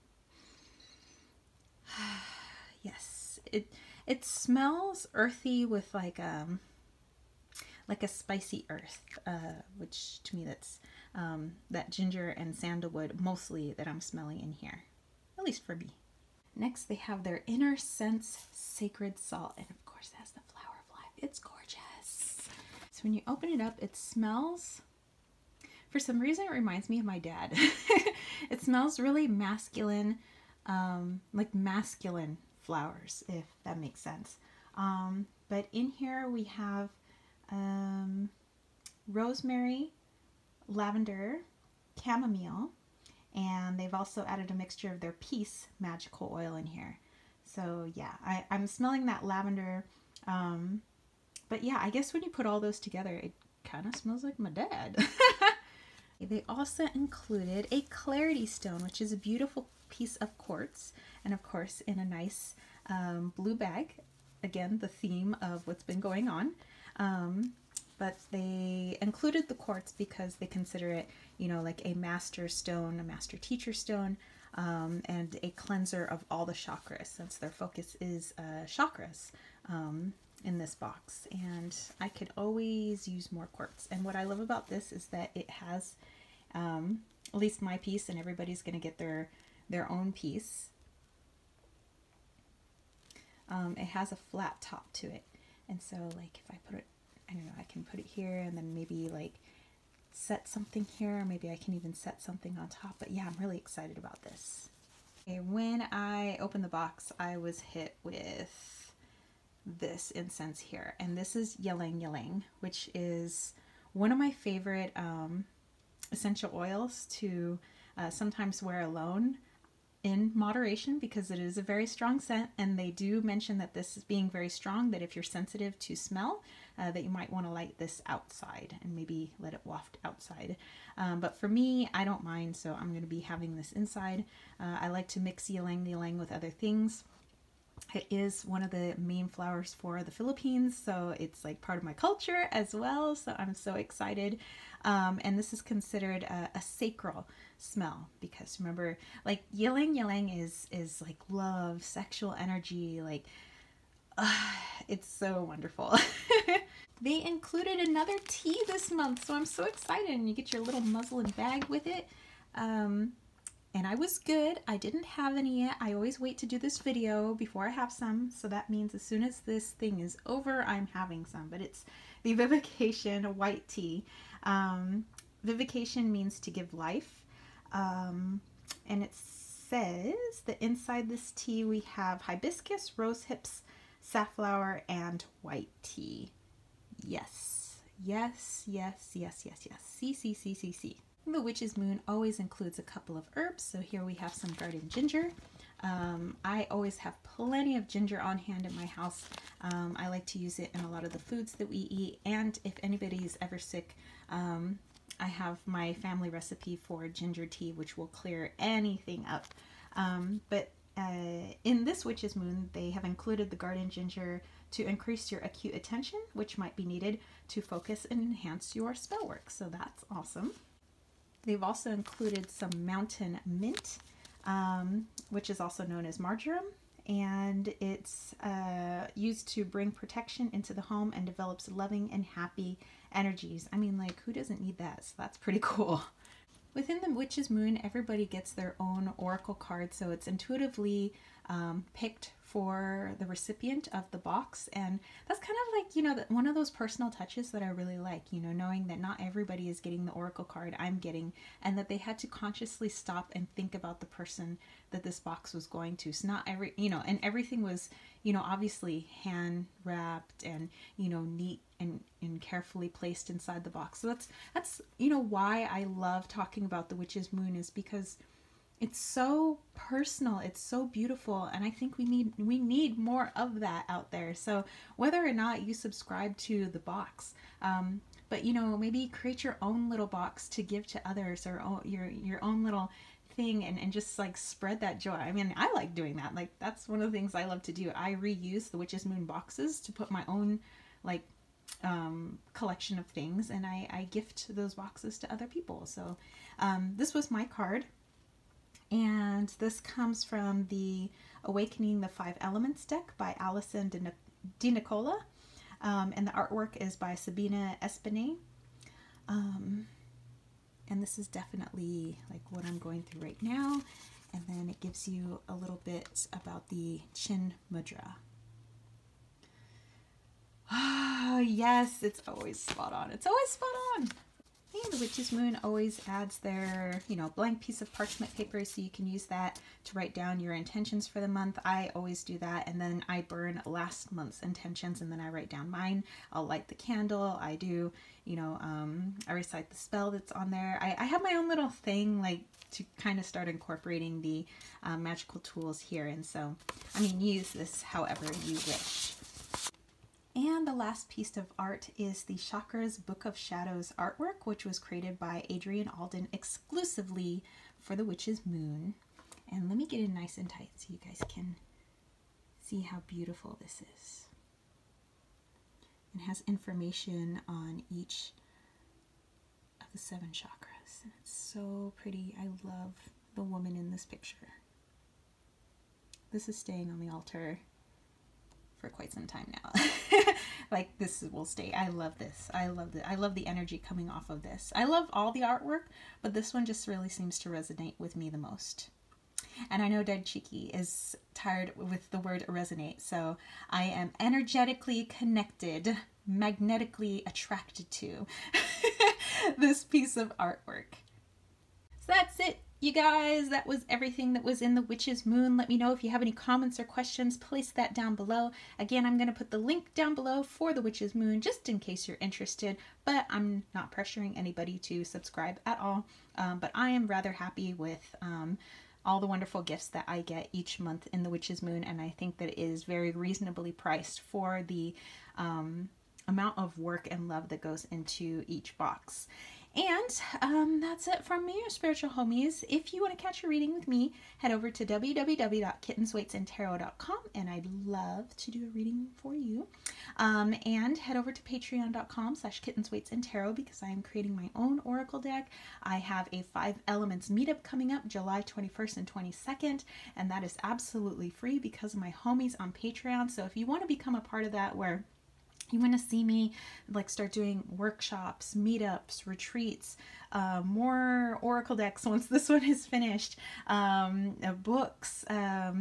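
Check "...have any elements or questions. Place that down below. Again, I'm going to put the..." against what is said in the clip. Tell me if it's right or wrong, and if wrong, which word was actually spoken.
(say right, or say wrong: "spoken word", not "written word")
wrong: "comments", not "elements".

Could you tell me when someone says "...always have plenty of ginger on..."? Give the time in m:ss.
3:16.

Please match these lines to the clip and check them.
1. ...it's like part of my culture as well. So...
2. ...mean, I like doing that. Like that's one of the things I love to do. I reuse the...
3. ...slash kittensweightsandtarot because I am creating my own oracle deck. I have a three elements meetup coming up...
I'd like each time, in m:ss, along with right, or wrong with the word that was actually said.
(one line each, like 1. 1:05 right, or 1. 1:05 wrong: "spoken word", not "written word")
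1. 2:21 right
2. 4:45 right
3. 7:22 wrong: "five", not "three".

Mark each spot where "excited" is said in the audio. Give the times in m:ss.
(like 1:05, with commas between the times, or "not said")
1:43, 2:23, 2:39.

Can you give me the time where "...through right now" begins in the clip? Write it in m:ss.
5:13.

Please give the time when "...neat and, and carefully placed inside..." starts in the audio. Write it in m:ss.
4:21.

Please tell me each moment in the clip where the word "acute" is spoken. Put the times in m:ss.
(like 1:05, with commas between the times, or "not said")
3:35.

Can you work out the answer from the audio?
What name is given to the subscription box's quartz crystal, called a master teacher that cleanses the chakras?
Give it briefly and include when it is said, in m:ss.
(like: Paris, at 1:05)
clarity stone, at 0:57.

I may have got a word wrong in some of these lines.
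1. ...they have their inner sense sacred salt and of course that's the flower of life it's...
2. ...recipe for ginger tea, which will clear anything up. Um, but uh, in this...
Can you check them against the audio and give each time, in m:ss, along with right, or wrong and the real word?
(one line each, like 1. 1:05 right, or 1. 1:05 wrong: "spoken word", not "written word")
1. 0:16 right
2. 3:26 right.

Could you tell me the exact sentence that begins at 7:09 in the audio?
And um, that's it from me, your spiritual homies.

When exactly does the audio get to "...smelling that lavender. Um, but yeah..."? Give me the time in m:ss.
0:48.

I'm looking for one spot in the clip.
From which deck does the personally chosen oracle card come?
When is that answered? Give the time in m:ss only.
5:01.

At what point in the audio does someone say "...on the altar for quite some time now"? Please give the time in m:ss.
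6:16.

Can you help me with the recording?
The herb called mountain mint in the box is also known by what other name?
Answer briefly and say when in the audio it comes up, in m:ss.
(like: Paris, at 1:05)
marjoram, at 3:46.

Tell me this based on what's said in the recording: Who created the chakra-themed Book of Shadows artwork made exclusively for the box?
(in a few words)
Adrian Alden.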